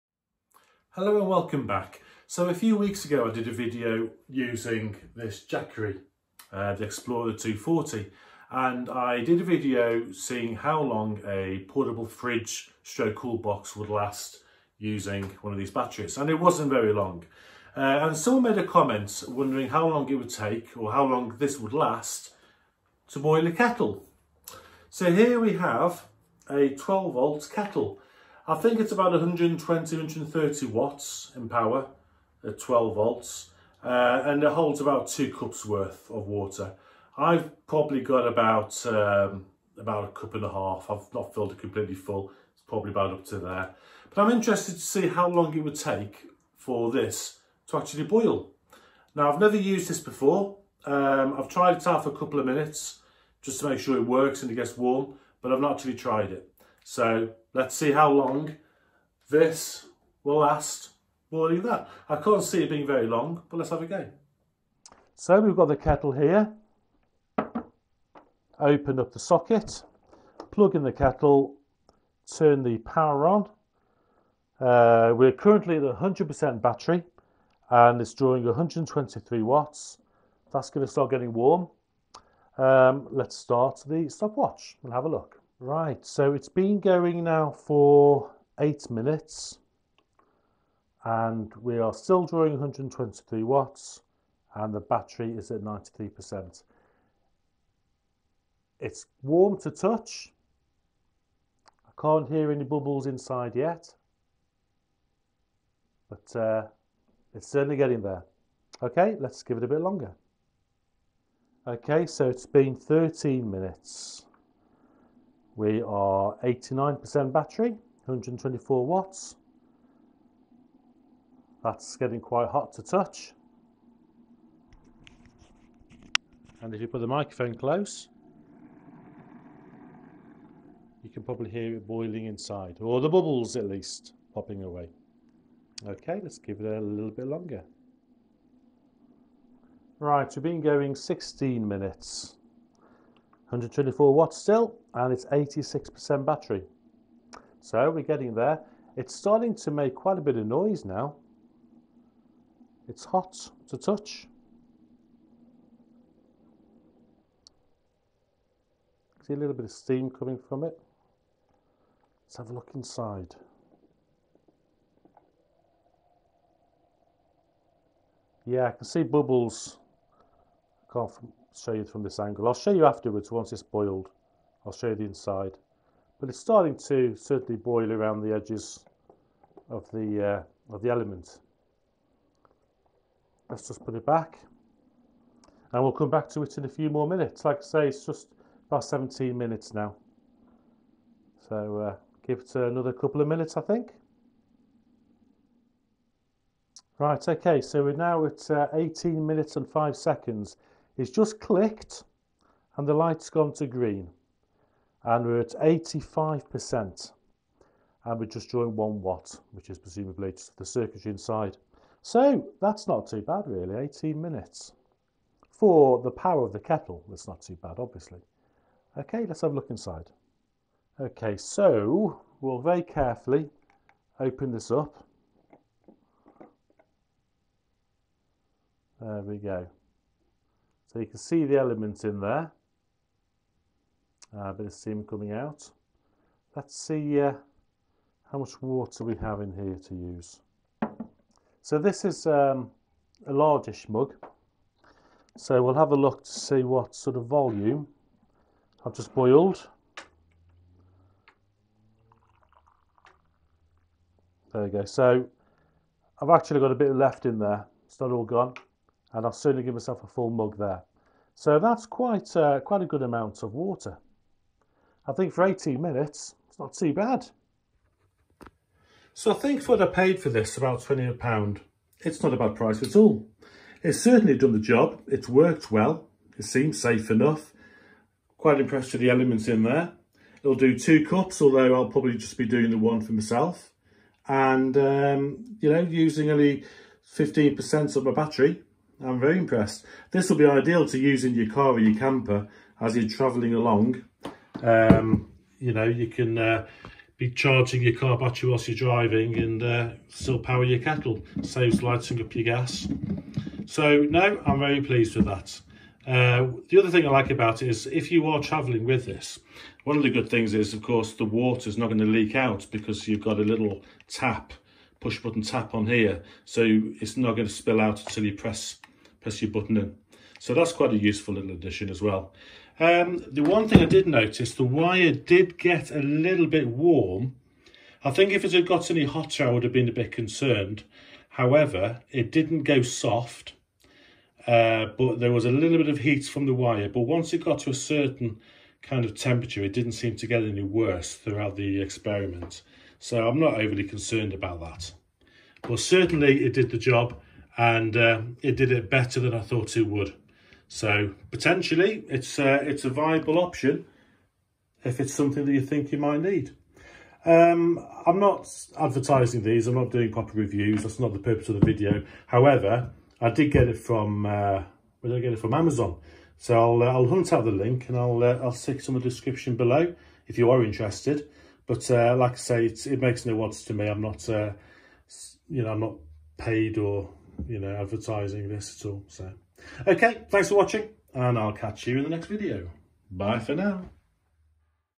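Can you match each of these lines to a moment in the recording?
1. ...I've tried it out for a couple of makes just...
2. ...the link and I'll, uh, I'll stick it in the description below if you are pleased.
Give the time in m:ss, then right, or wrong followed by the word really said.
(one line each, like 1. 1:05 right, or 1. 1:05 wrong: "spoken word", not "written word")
1. 0:51 wrong: "minutes", not "makes"
2. 6:07 wrong: "interested", not "pleased".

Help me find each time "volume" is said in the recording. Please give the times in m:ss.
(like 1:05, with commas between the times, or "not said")
4:07.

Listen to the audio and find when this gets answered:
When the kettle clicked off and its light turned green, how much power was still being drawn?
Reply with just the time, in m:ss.
3:28.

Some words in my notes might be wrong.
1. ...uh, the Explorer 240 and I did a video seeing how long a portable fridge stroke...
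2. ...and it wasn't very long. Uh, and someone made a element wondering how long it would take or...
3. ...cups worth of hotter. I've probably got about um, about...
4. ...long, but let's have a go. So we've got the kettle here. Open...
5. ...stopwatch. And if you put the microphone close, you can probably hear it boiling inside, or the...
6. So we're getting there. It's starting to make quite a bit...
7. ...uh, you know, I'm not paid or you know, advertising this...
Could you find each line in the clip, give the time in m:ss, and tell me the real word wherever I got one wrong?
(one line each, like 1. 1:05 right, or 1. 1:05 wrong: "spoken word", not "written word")
1. 0:06 right
2. 0:16 wrong: "comment", not "element"
3. 0:35 wrong: "water", not "hotter"
4. 1:03 right
5. 2:02 wrong: "touch", not "stopwatch"
6. 2:27 right
7. 6:14 right.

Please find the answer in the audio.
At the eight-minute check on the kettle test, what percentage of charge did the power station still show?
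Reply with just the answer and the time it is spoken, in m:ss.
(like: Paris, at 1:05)
93%, at 1:35.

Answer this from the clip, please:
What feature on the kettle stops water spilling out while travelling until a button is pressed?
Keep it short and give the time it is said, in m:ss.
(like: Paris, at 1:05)
push button tap, at 5:14.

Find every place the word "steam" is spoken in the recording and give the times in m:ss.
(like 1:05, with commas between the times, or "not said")
2:39, 3:54.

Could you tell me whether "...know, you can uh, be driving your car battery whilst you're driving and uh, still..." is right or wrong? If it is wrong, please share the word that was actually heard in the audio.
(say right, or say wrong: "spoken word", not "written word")
wrong: "charging", not "driving".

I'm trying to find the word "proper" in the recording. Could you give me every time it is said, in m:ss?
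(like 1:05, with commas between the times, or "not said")
6:00.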